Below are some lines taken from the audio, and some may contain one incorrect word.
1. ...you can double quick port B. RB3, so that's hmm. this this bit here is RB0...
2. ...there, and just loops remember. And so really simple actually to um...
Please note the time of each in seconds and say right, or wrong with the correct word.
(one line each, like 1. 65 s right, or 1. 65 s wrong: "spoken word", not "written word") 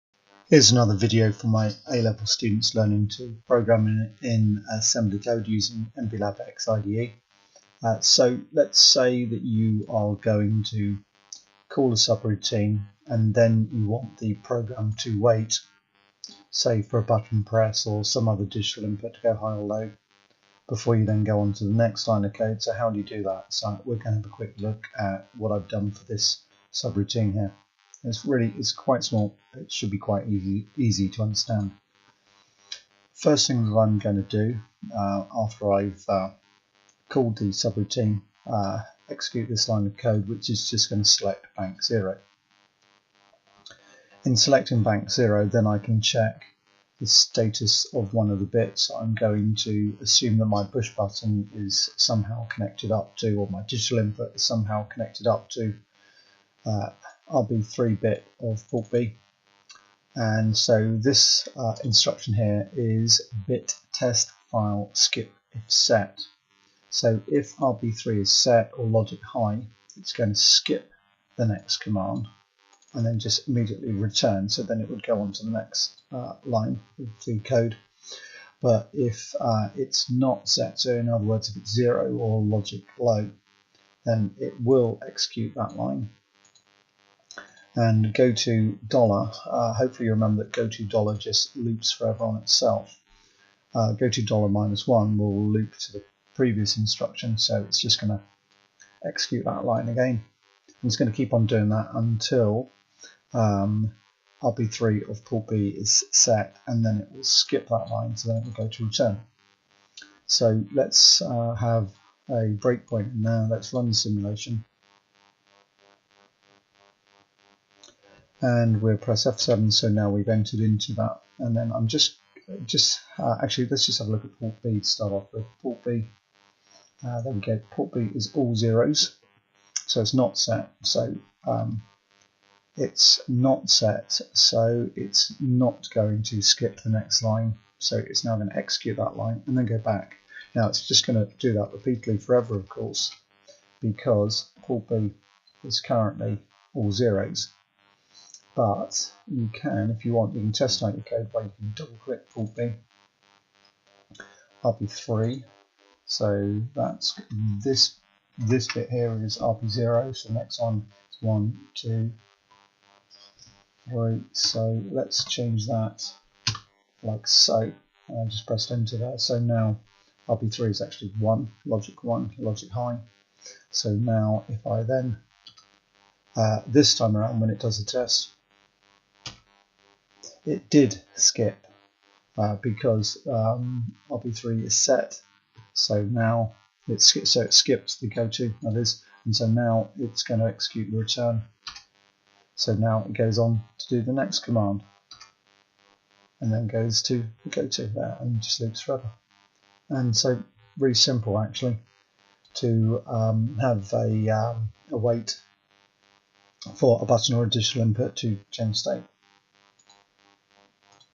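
1. 151 s wrong: "click", not "quick"
2. 197 s wrong: "forever", not "remember".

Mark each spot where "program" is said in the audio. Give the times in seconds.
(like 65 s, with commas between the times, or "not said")
3 s, 14 s.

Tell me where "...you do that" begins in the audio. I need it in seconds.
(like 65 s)
22 s.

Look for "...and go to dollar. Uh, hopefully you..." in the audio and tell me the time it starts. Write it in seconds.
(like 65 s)
87 s.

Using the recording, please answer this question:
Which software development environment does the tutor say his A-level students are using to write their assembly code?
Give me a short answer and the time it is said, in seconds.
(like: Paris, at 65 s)
MPLAB X IDE, at 5 s.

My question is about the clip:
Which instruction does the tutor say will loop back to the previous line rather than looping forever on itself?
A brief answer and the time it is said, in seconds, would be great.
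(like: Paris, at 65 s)
go to dollar minus one, at 93 s.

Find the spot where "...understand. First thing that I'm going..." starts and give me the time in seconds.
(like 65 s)
31 s.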